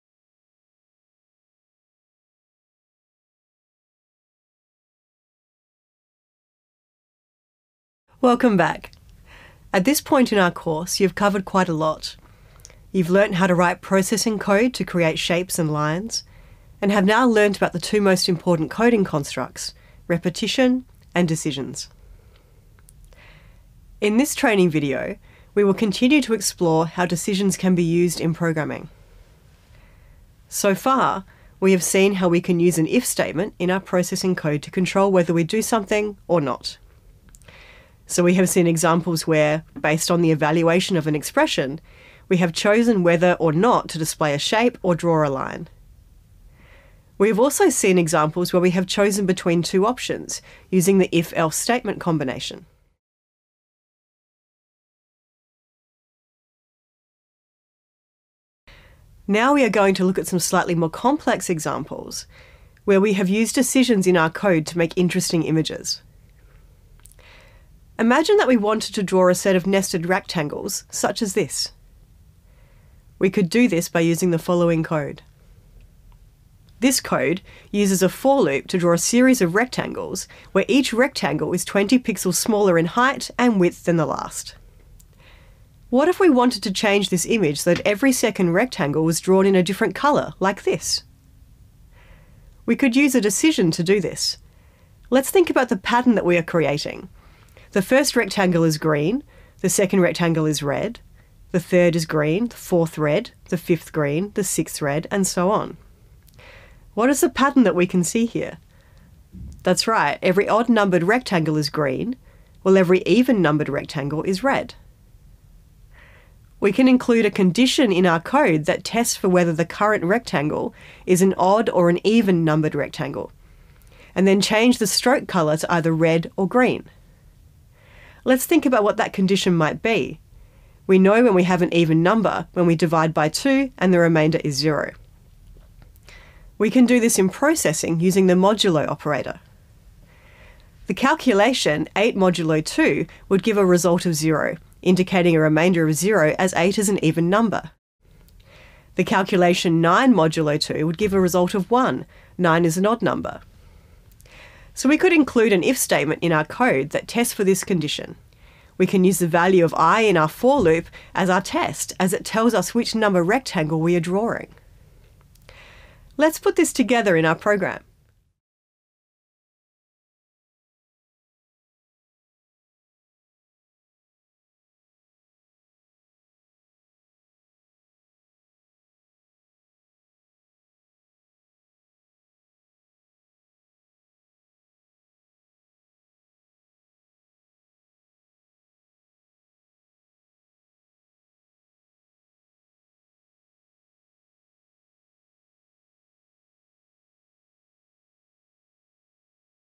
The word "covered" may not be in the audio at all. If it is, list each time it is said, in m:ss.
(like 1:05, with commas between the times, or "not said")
0:11.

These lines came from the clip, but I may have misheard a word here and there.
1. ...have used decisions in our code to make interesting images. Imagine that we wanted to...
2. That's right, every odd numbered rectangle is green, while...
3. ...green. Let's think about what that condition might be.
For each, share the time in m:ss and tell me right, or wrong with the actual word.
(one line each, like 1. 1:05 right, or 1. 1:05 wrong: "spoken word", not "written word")
1. 1:03 right
2. 1:49 right
3. 2:06 right.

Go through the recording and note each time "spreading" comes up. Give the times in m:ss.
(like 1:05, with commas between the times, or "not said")
not said.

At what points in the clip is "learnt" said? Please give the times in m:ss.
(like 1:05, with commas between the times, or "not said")
0:13, 0:17.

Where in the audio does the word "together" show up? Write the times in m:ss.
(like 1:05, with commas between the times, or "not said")
2:46.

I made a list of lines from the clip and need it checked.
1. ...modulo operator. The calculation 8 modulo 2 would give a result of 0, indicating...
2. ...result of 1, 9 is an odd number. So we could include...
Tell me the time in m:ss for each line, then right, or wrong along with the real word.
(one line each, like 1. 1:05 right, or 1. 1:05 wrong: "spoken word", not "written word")
1. 2:18 right
2. 2:31 right.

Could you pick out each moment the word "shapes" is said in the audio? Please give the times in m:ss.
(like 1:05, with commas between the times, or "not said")
0:15, 0:44.